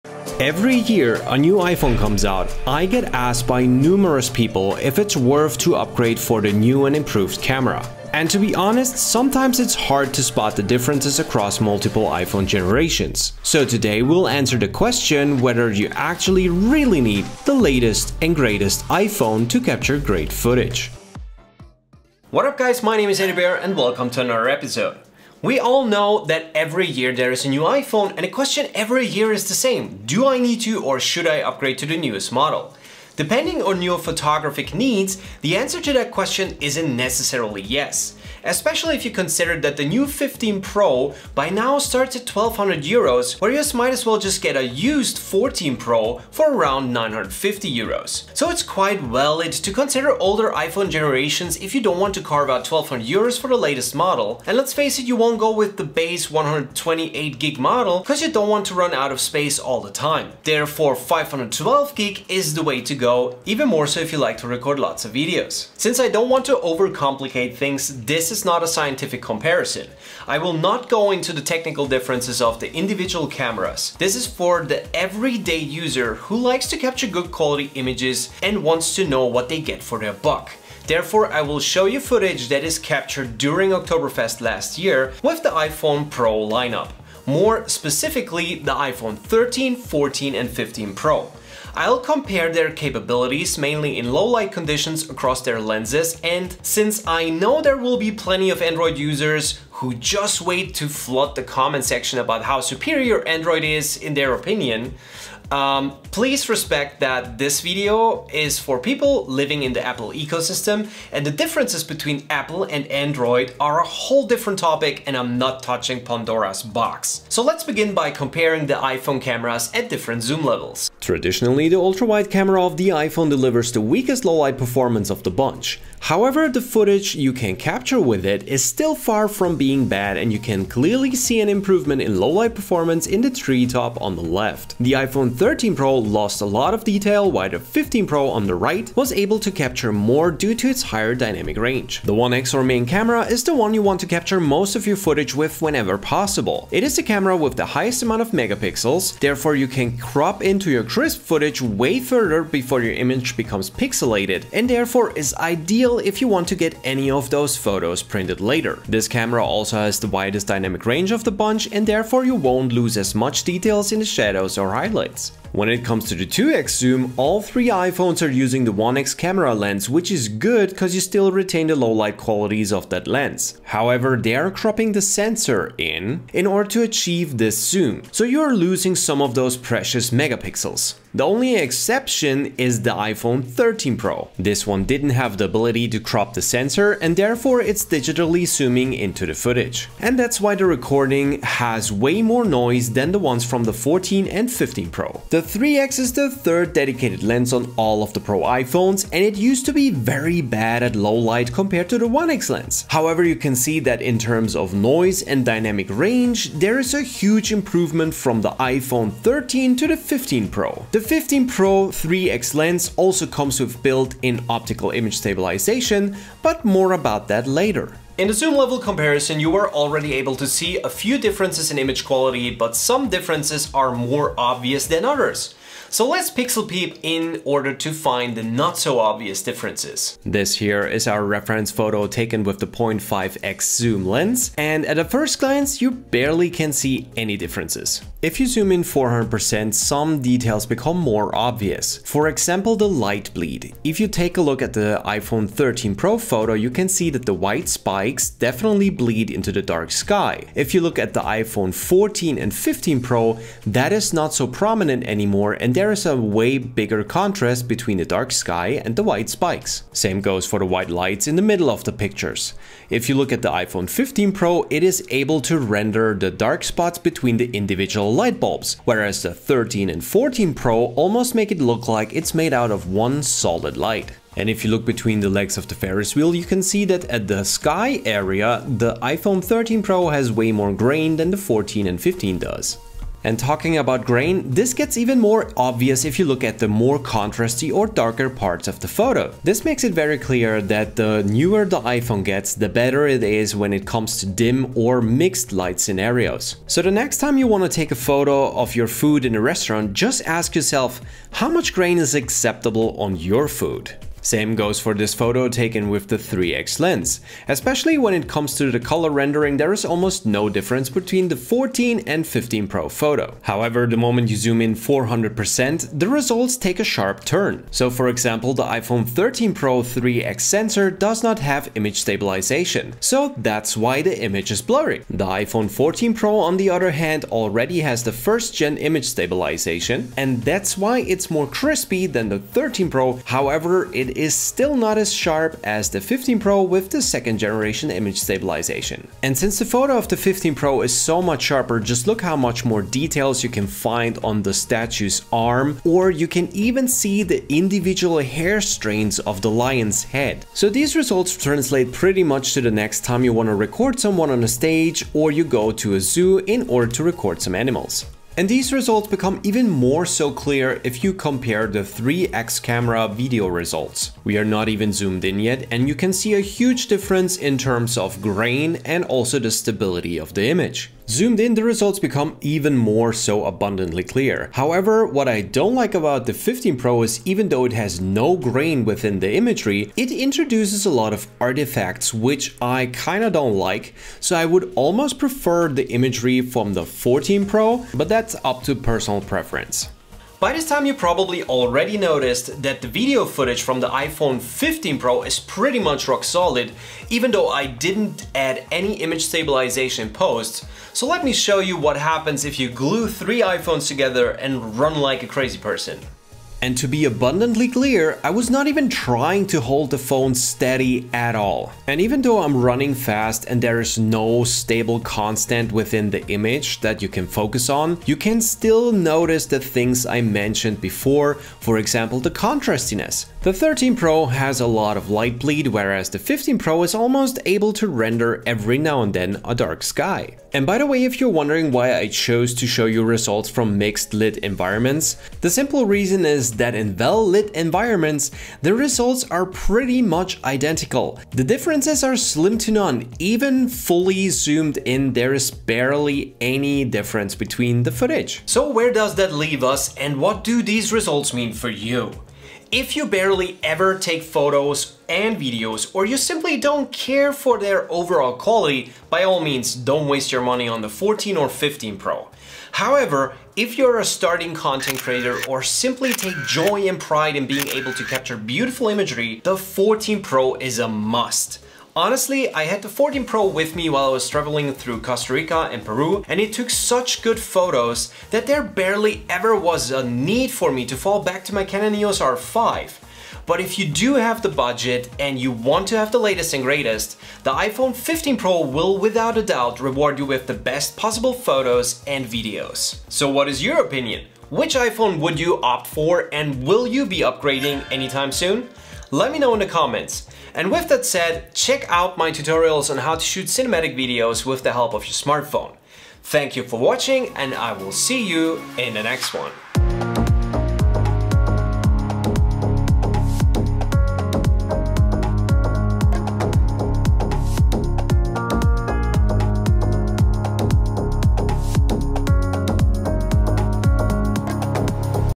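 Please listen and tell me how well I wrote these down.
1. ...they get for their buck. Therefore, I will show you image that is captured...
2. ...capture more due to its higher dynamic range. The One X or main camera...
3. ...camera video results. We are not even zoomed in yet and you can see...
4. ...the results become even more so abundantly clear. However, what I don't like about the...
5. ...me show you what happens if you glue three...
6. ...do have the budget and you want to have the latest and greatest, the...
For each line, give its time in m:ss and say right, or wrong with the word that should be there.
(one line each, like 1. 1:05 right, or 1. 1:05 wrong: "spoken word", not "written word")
1. 1:19 wrong: "footage", not "image"
2. 2:19 right
3. 6:02 right
4. 6:11 right
5. 6:41 right
6. 8:03 right.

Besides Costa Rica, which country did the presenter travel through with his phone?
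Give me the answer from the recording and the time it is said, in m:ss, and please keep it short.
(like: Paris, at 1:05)
Peru, at 7:55.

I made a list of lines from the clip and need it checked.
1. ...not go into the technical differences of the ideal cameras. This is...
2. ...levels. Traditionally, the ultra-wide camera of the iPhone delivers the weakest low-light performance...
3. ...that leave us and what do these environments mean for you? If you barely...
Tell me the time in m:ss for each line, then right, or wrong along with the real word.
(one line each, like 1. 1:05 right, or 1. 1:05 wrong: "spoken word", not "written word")
1. 1:10 wrong: "individual", not "ideal"
2. 2:00 right
3. 7:29 wrong: "results", not "environments".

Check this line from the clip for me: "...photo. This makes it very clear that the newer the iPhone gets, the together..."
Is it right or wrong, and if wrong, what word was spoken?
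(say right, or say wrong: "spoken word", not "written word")
wrong: "better", not "together".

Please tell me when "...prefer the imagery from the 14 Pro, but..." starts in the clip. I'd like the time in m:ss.
6:25.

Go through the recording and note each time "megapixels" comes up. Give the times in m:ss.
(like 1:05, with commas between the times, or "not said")
2:28, 3:00.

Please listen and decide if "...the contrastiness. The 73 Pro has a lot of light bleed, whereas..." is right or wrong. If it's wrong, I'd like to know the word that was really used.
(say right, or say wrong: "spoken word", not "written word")
wrong: "13", not "73".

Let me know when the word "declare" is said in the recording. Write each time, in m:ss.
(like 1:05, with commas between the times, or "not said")
not said.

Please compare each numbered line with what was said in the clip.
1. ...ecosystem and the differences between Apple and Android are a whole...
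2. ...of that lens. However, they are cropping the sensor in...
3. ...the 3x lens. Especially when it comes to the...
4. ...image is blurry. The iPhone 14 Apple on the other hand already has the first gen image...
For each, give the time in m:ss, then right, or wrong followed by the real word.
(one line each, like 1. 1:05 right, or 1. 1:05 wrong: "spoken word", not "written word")
1. 1:50 right
2. 2:52 right
3. 5:06 right
4. 5:24 wrong: "Pro", not "Apple".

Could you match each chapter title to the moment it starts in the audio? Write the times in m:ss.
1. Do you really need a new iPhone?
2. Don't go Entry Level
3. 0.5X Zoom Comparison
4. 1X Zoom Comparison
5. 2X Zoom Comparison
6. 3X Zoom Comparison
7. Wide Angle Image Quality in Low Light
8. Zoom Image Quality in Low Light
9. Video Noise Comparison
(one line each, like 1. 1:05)
1. 0:22
2. 0:56
3. 2:00
4. 2:22
5. 2:45
6. 3:15
7. 3:38
8. 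5:04
9. 5:58.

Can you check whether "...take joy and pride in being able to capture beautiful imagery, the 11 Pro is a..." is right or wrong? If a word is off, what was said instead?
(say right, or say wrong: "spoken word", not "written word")
wrong: "14", not "11".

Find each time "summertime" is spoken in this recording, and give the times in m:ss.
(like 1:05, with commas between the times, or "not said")
not said.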